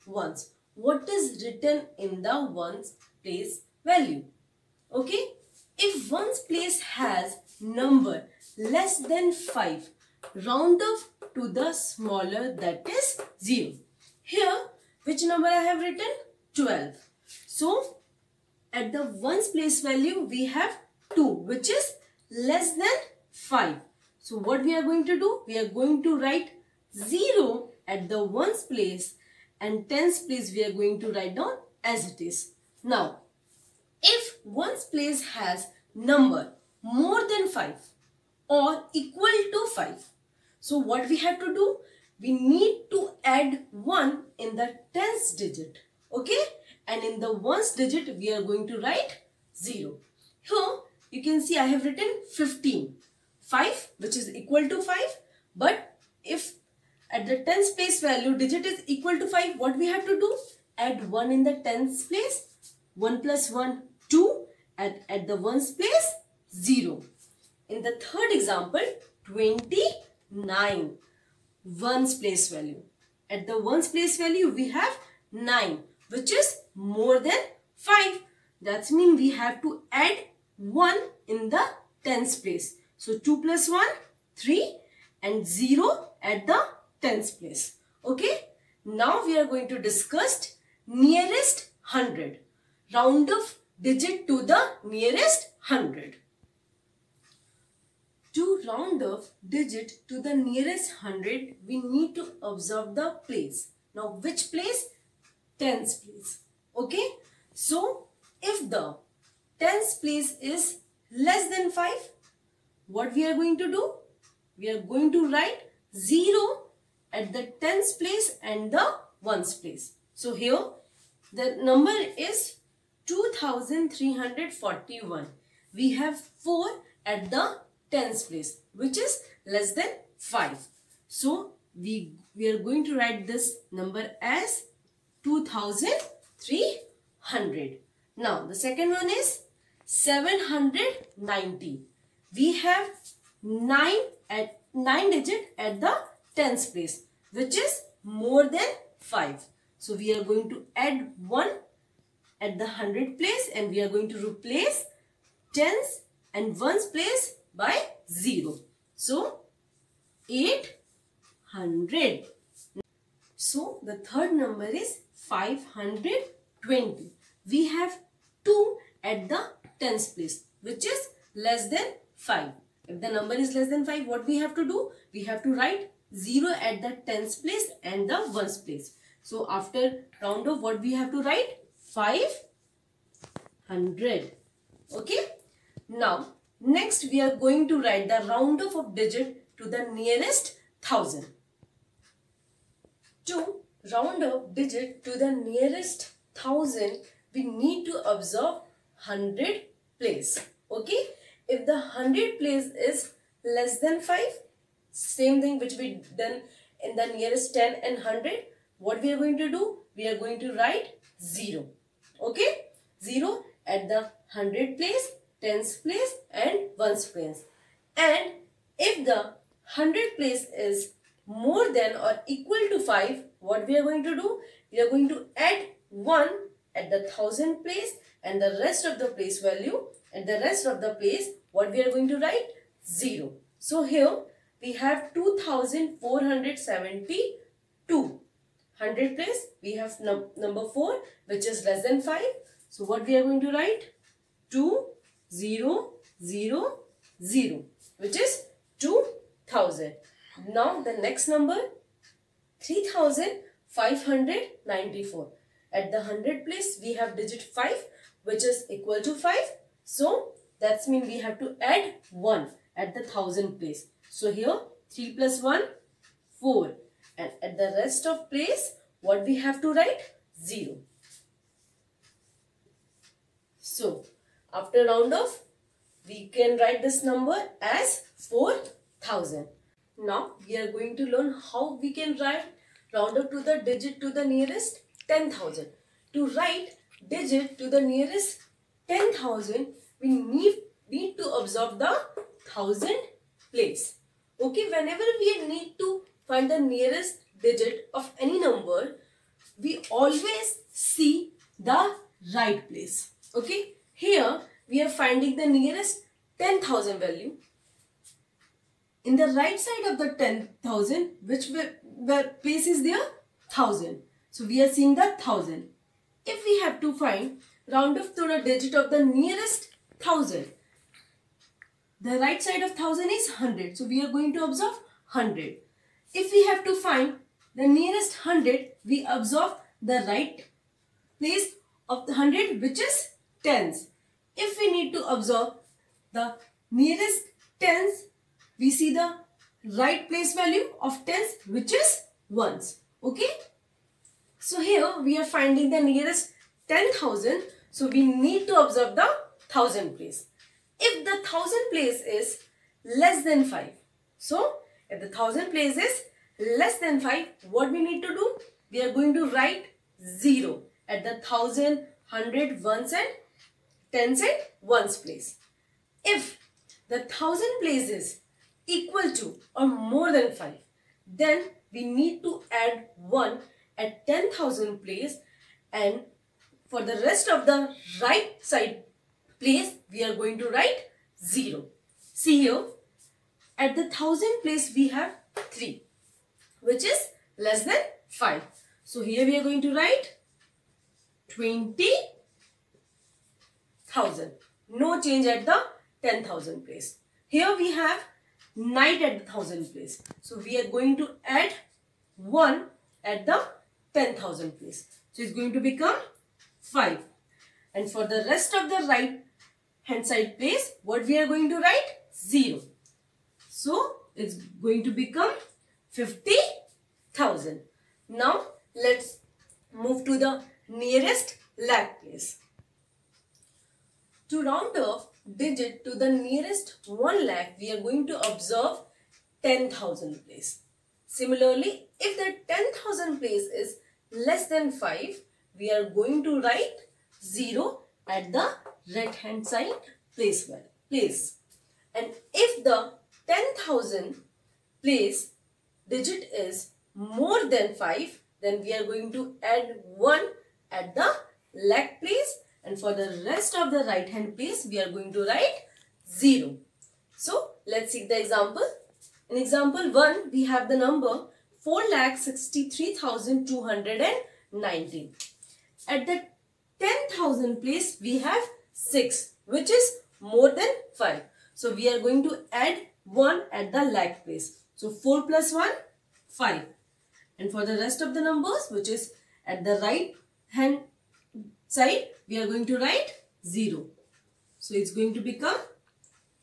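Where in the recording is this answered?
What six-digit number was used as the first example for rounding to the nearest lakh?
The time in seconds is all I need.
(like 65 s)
461 s.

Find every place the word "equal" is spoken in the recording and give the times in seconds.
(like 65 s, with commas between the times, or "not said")
38 s, 54 s, 58 s, 222 s, 258 s, 368 s.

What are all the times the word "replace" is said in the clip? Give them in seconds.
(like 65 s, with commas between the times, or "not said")
154 s.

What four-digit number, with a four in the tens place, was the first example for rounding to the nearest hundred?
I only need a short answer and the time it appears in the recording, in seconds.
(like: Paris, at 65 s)
2341, at 123 s.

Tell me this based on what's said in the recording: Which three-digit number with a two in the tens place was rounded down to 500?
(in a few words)
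520.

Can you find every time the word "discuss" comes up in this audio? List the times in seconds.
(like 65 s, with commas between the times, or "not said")
89 s.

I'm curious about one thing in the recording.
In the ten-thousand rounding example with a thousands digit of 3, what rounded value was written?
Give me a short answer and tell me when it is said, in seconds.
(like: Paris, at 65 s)
20,000, at 391 s.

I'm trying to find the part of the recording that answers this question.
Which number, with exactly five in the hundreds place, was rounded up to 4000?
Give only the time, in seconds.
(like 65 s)
252 s.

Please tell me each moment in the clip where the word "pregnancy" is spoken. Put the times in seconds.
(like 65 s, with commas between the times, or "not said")
not said.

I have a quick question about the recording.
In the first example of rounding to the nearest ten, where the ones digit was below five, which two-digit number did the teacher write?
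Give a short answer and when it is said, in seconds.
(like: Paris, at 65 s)
12, at 16 s.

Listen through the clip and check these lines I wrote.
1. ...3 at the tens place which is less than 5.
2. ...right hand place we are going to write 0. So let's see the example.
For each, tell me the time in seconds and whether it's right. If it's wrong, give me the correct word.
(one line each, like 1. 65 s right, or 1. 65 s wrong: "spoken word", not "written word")
1. 168 s wrong: "2", not "3"
2. 453 s right.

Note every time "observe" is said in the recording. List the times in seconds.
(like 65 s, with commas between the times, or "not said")
102 s, 198 s, 291 s, 324 s, 329 s, 335 s, 348 s, 428 s.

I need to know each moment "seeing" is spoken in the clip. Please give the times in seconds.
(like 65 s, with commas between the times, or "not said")
314 s.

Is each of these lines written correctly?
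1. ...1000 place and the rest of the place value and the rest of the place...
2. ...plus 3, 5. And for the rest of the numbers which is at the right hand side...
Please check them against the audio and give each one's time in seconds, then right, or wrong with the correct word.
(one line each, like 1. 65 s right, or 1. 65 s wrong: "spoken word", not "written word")
1. 227 s right
2. 475 s wrong: "1", not "3".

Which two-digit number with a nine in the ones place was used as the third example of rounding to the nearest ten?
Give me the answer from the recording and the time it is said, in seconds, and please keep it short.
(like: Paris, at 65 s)
29, at 69 s.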